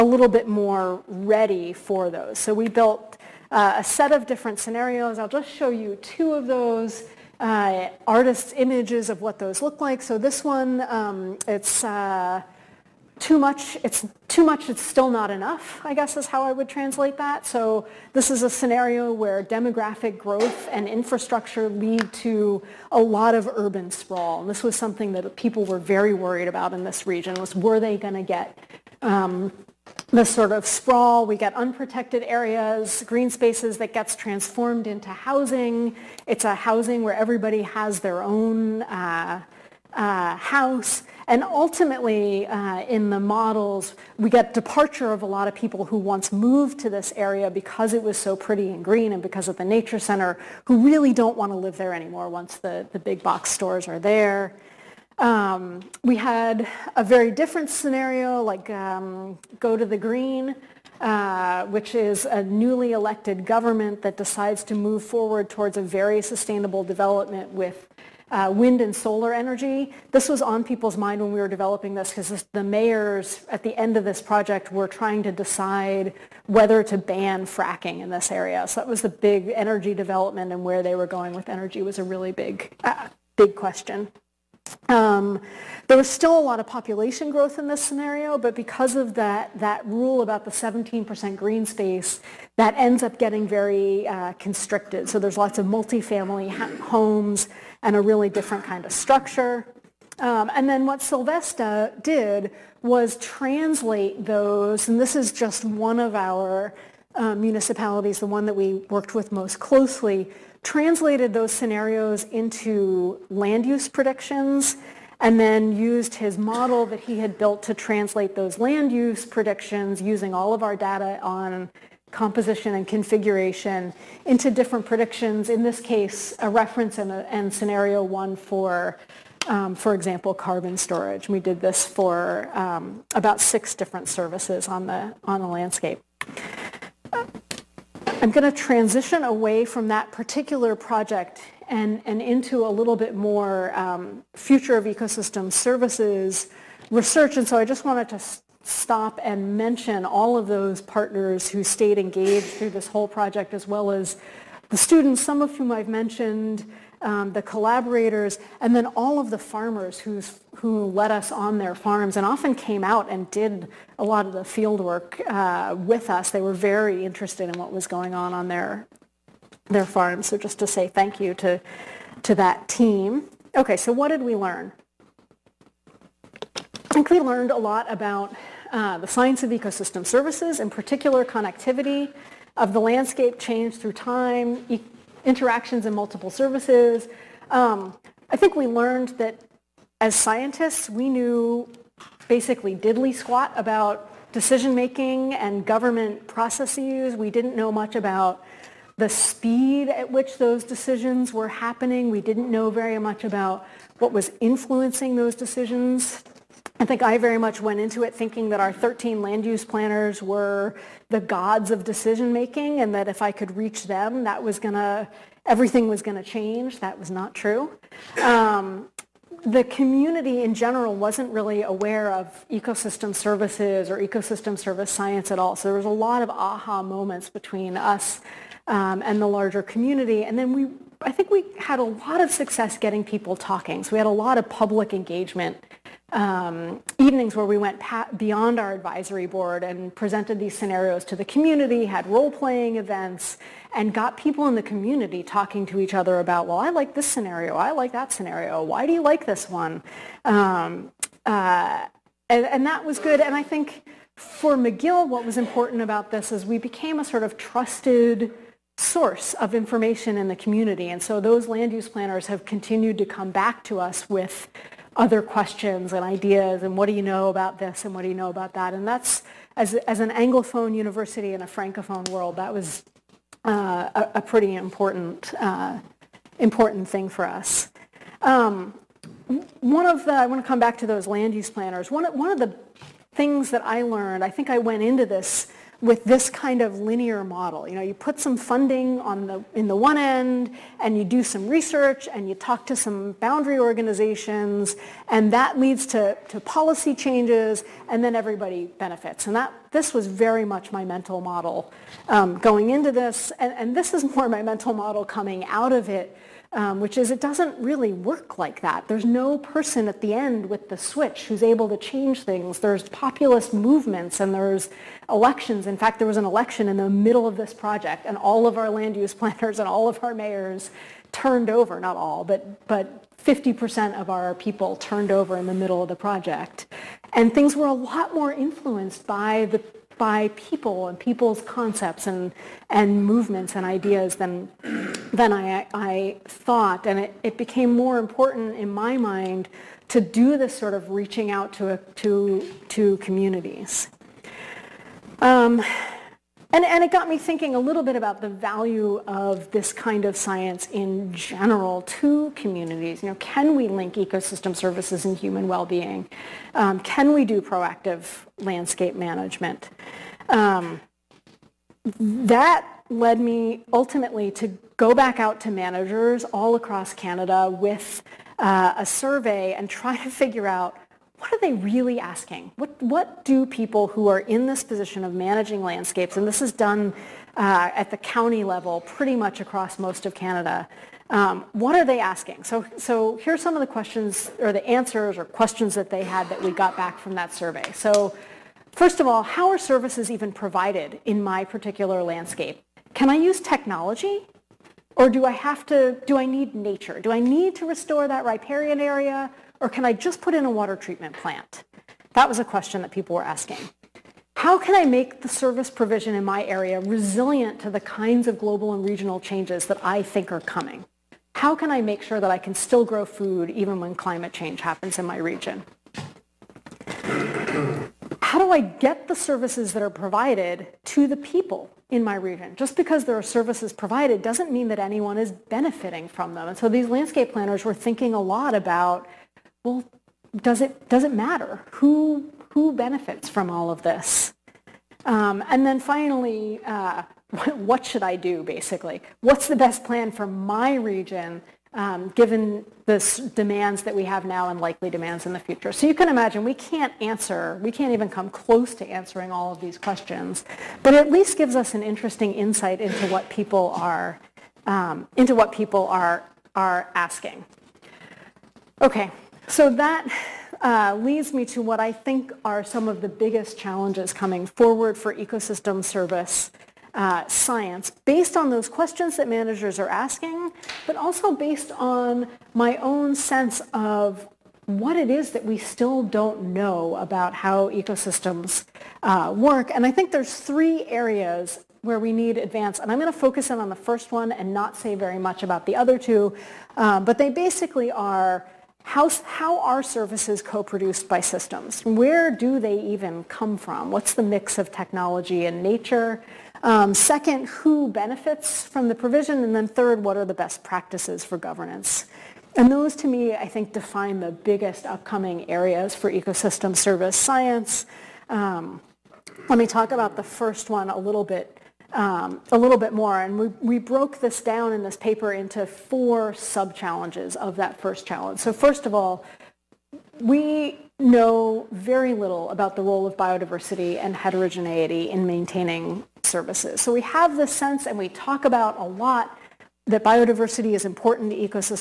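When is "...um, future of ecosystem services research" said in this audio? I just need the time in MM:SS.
02:23.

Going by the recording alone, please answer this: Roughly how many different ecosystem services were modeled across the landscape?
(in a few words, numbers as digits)
six.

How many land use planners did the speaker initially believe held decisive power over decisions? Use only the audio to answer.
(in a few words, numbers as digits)
13.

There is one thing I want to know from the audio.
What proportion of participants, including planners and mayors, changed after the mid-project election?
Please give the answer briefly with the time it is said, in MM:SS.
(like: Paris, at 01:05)
50%, at 05:23.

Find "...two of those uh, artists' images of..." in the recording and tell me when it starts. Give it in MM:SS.
00:06.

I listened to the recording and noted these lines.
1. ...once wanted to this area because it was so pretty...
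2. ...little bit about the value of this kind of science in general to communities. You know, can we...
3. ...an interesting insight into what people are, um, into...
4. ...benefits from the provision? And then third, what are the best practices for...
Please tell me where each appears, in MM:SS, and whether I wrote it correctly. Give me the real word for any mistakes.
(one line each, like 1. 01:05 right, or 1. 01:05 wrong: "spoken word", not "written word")
1. 00:45 wrong: "moved", not "wanted"
2. 05:47 right
3. 07:31 right
4. 08:17 right.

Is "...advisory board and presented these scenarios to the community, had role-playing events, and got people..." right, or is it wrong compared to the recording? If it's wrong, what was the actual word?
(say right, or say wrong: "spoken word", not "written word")
right.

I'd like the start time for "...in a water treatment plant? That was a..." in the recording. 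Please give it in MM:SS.
06:40.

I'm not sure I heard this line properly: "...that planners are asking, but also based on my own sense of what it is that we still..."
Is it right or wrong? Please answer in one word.
wrong.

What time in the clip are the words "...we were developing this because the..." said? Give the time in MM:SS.
01:11.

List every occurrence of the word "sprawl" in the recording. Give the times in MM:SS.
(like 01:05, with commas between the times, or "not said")
00:23, 00:30.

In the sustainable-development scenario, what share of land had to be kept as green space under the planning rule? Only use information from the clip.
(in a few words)
17%.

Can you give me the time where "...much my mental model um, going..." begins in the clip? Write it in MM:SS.
05:00.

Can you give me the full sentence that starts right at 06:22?
So, so are some of the questions or the answers or questions that they had that we got back from that survey.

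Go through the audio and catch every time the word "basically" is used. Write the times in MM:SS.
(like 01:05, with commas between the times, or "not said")
03:12, 07:18, 08:07.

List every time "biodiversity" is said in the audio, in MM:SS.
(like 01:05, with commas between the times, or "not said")
08:43, 08:50.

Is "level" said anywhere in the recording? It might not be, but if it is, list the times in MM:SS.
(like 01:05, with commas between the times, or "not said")
06:18.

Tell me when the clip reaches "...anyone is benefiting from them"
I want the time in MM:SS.
07:04.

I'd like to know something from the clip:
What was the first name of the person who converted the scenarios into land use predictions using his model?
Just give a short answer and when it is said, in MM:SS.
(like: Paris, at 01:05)
Sylvester, at 01:41.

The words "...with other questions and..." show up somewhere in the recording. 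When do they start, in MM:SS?
04:24.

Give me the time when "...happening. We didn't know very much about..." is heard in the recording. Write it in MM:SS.
03:21.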